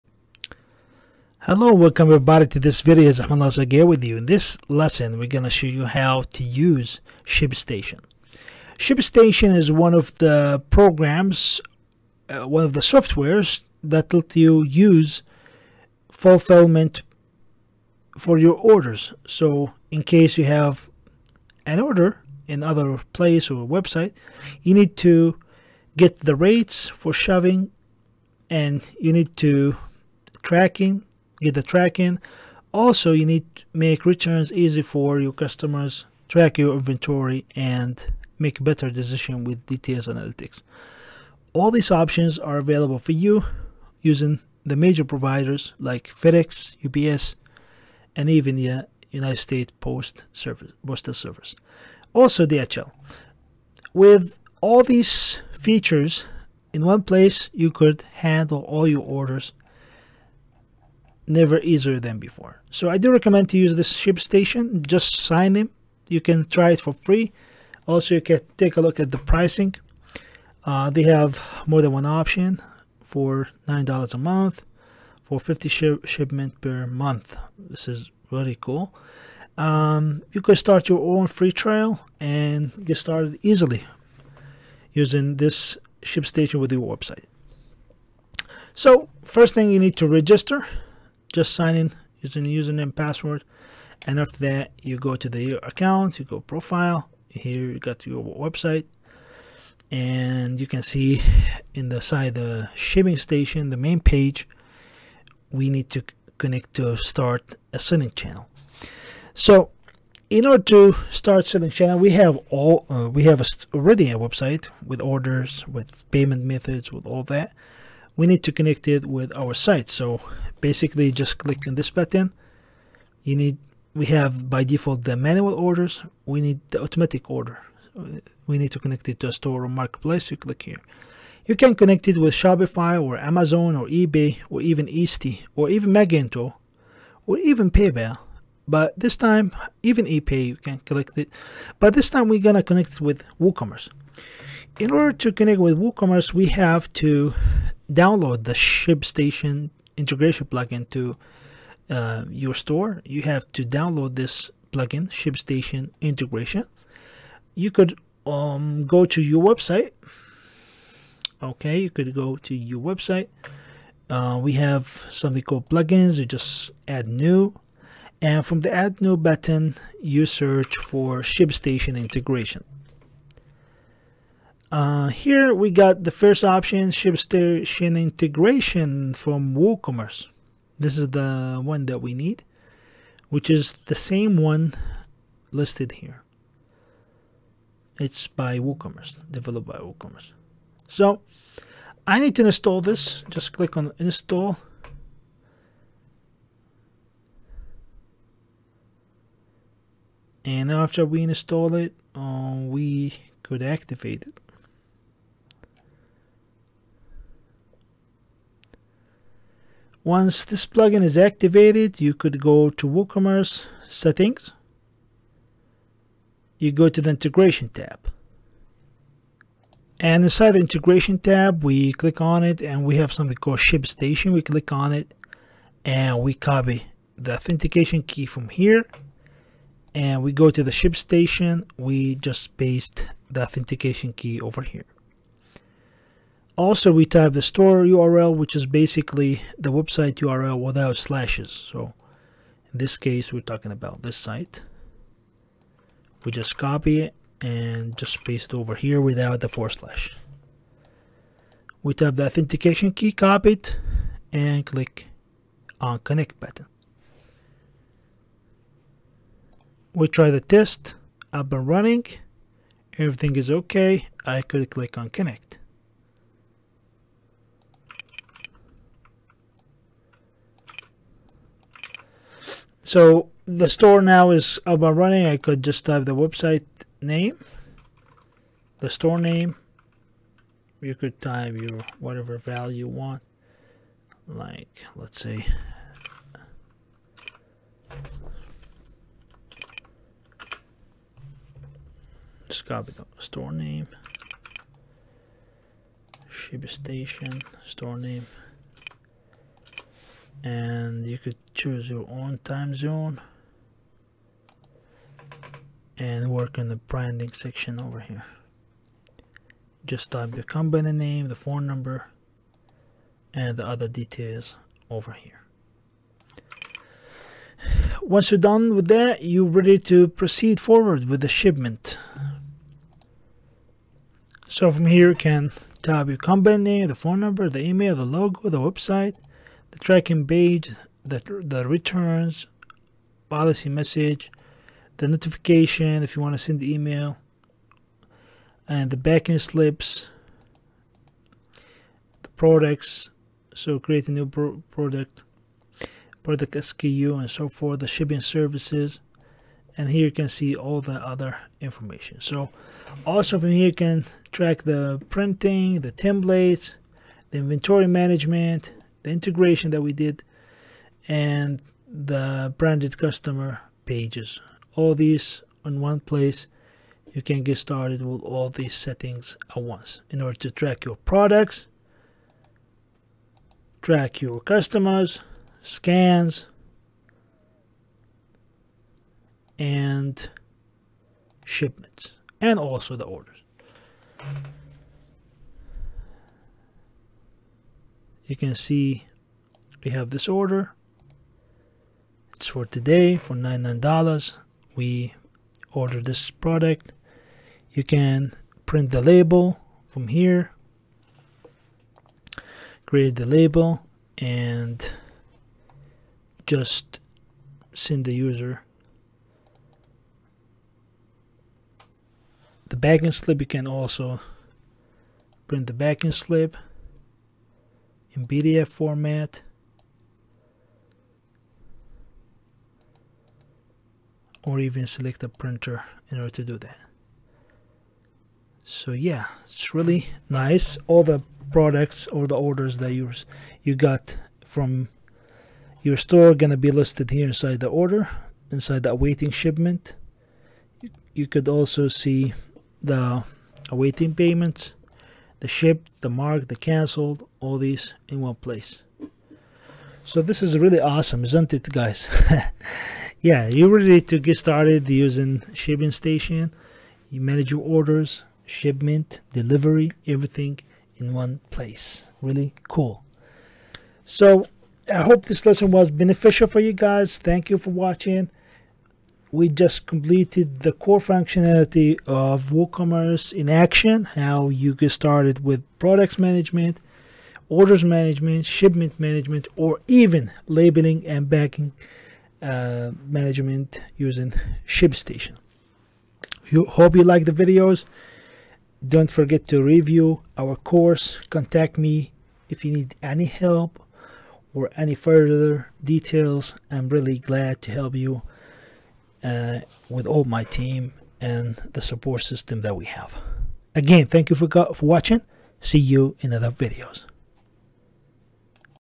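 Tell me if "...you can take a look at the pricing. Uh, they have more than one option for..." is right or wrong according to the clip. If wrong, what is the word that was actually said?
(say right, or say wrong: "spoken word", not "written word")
right.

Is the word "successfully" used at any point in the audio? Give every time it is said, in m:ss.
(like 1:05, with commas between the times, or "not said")
not said.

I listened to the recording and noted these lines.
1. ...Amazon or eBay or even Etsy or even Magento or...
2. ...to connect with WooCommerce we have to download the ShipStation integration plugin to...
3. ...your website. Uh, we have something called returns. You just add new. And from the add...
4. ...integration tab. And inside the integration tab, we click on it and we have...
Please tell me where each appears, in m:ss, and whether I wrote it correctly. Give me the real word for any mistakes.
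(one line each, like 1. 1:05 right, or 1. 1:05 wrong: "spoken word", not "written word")
1. 2:13 right
2. 2:25 right
3. 2:42 wrong: "plugins", not "returns"
4. 3:37 right.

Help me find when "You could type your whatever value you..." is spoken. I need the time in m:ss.
4:40.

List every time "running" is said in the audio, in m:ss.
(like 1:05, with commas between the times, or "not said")
4:21, 4:34.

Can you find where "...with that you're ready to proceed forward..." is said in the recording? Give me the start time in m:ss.
5:18.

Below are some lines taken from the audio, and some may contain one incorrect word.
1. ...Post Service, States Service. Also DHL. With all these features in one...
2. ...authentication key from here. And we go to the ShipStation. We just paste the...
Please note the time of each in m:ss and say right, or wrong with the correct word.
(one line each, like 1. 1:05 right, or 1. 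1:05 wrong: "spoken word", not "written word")
1. 0:49 wrong: "Postal", not "States"
2. 3:47 right.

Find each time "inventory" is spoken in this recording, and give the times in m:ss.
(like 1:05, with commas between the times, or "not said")
0:36, 5:57.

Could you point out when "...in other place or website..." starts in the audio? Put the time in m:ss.
0:22.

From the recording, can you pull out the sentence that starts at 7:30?
So this is really awesome, isn't it guys?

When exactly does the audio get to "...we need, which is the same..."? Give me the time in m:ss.
3:02.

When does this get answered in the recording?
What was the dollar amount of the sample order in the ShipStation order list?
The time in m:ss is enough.
6:33.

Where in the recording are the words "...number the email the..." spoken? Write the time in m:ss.
5:27.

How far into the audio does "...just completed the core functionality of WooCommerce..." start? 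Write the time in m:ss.
7:49.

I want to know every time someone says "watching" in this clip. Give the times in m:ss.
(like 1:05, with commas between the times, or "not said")
7:47, 8:24.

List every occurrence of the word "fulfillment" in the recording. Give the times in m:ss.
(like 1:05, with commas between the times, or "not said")
0:16.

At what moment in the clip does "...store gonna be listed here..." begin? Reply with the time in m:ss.
7:15.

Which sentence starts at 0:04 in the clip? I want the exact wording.
In this lesson, we're going to show you how to use ShipStation.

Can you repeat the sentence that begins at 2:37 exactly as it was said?
You could um, go to your website.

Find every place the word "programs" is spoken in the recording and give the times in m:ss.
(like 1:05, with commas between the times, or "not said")
0:10.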